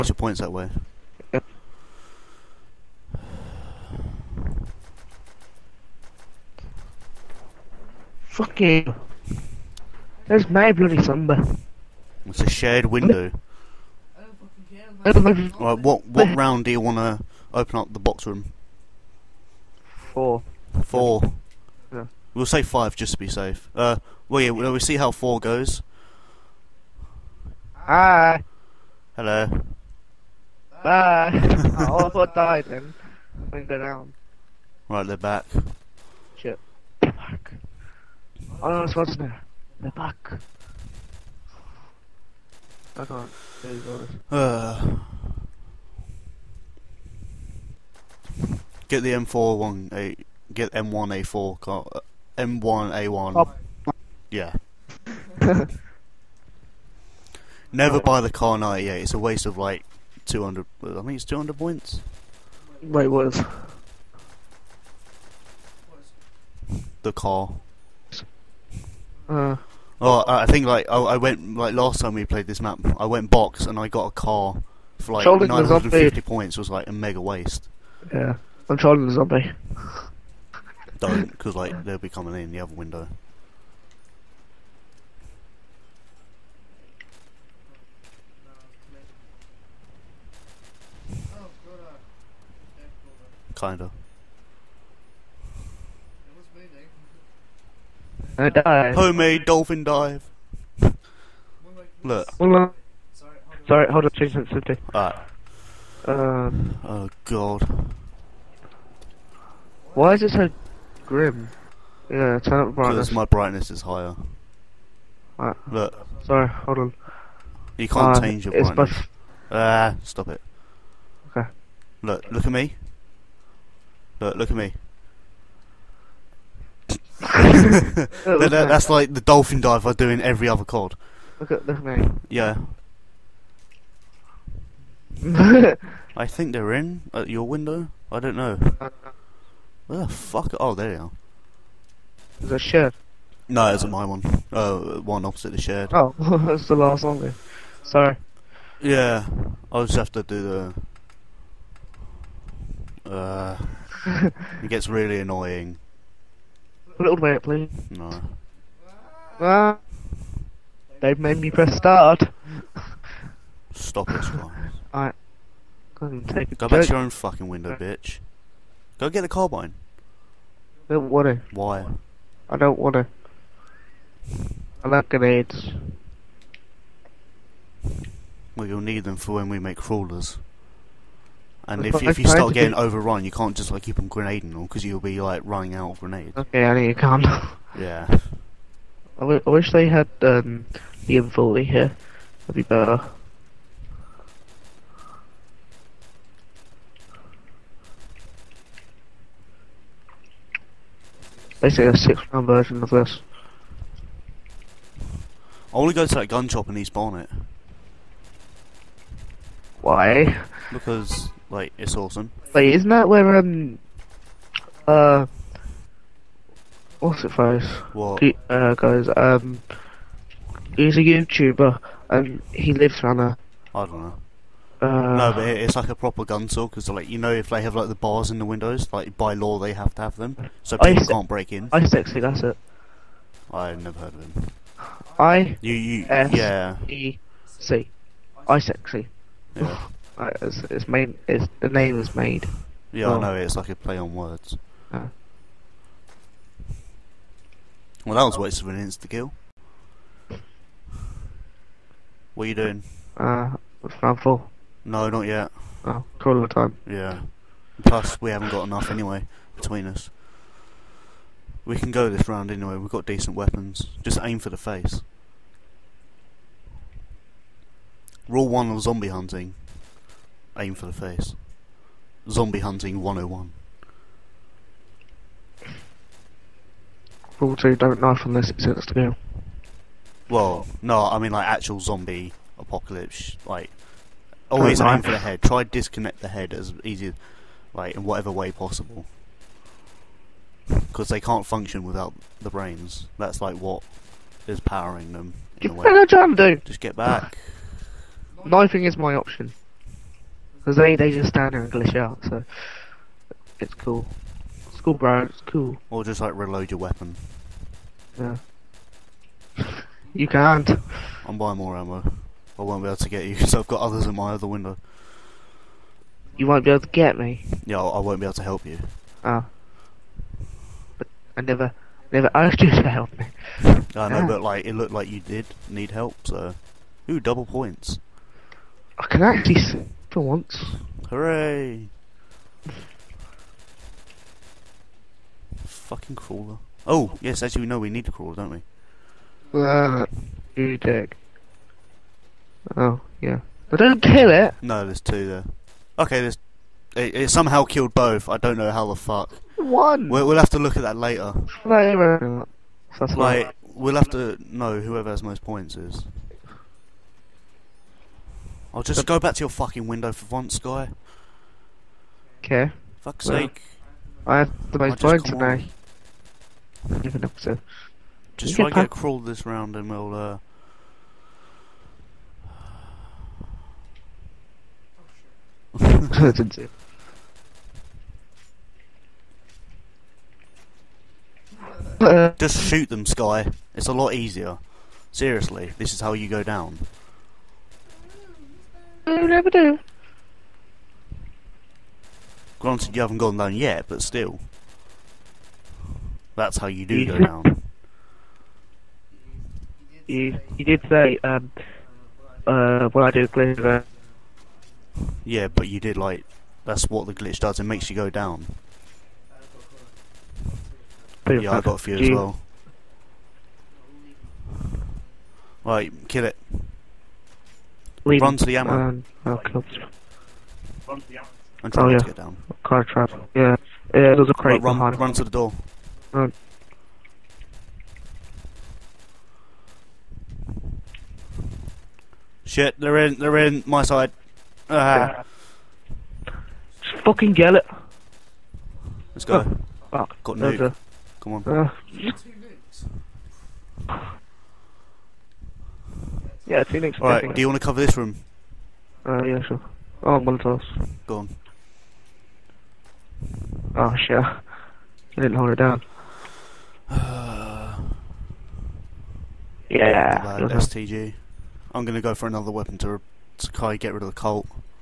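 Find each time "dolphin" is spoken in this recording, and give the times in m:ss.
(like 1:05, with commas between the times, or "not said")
1:39, 2:09.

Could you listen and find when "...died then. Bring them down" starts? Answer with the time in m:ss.
0:32.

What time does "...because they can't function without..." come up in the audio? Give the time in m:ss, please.
4:50.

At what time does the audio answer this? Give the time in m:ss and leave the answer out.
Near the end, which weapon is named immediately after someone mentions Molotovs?
7:40.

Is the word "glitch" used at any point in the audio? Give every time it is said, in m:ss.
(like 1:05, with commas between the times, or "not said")
5:01, 6:47.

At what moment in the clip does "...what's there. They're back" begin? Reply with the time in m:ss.
0:38.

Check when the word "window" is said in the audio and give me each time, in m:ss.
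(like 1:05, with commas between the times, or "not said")
0:12, 1:22, 2:17, 2:47, 3:48, 5:14, 5:59.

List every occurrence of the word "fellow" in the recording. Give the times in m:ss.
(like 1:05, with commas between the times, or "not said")
not said.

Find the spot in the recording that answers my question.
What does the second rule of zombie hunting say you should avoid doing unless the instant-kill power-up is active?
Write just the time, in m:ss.
4:37.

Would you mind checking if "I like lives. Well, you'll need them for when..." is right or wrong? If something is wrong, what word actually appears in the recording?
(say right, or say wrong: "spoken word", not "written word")
wrong: "grenades", not "lives".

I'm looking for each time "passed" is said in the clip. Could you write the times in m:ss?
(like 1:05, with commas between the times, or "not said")
not said.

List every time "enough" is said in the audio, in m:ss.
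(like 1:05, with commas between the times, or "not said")
4:18.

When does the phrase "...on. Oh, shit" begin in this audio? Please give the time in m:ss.
7:31.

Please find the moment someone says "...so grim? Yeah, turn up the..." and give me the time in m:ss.
1:50.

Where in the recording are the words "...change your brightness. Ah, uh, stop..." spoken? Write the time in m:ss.
1:58.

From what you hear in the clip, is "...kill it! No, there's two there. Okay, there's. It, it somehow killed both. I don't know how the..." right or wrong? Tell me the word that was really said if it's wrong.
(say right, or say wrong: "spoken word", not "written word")
right.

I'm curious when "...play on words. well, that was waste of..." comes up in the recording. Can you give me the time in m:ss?
4:03.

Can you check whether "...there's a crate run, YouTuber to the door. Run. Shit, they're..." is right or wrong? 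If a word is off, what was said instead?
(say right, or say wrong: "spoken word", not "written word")
wrong: "Run", not "YouTuber".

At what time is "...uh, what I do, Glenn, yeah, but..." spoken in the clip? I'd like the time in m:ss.
6:42.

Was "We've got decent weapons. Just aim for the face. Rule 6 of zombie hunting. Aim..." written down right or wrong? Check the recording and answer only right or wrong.
wrong.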